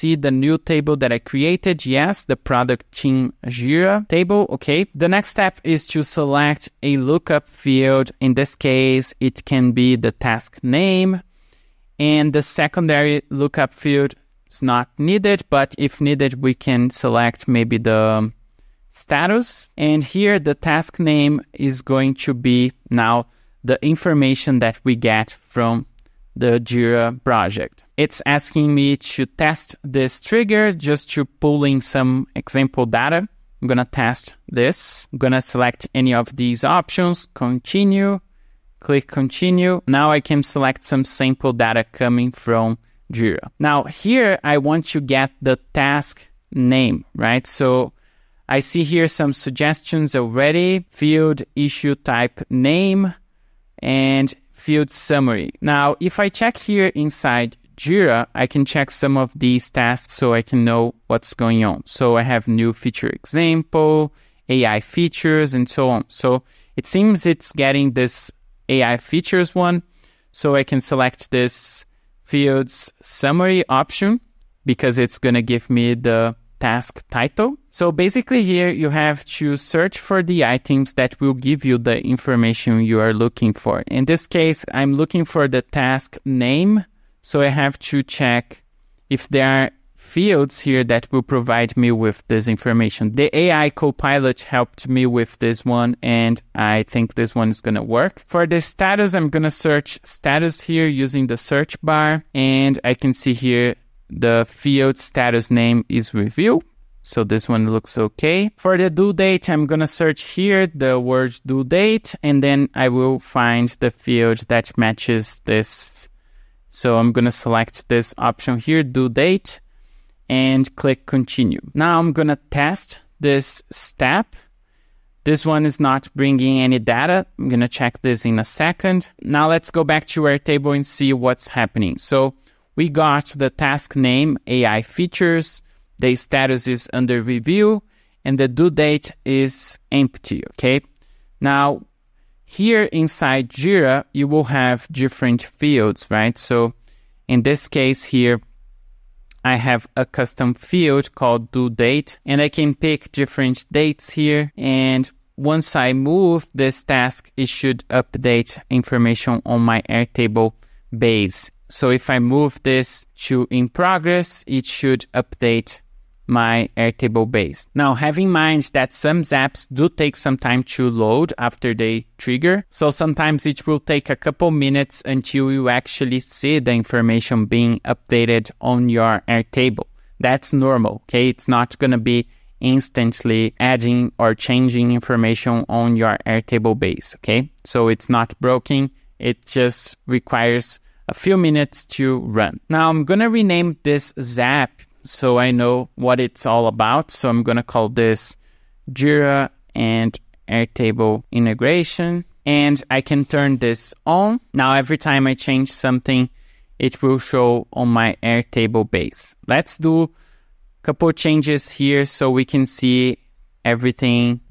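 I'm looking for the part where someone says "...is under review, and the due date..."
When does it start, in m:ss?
2:16.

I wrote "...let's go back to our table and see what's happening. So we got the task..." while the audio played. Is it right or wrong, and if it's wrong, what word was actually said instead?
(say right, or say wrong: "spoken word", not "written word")
right.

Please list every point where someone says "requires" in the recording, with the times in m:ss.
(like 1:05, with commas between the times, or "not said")
3:10.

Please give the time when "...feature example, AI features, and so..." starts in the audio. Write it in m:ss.
1:02.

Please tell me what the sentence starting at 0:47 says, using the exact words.
So I see here some suggestions already field issue type name and field summary.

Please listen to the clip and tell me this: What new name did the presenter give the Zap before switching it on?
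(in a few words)
Jira and Airtable integration.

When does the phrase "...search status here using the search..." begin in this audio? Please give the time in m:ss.
1:39.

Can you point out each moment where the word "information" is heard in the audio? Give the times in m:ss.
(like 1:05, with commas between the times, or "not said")
0:23, 1:22, 1:32, 2:38, 2:56, 3:04.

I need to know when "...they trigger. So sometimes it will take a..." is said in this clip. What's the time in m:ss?
2:51.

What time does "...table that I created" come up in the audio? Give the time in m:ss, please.
0:00.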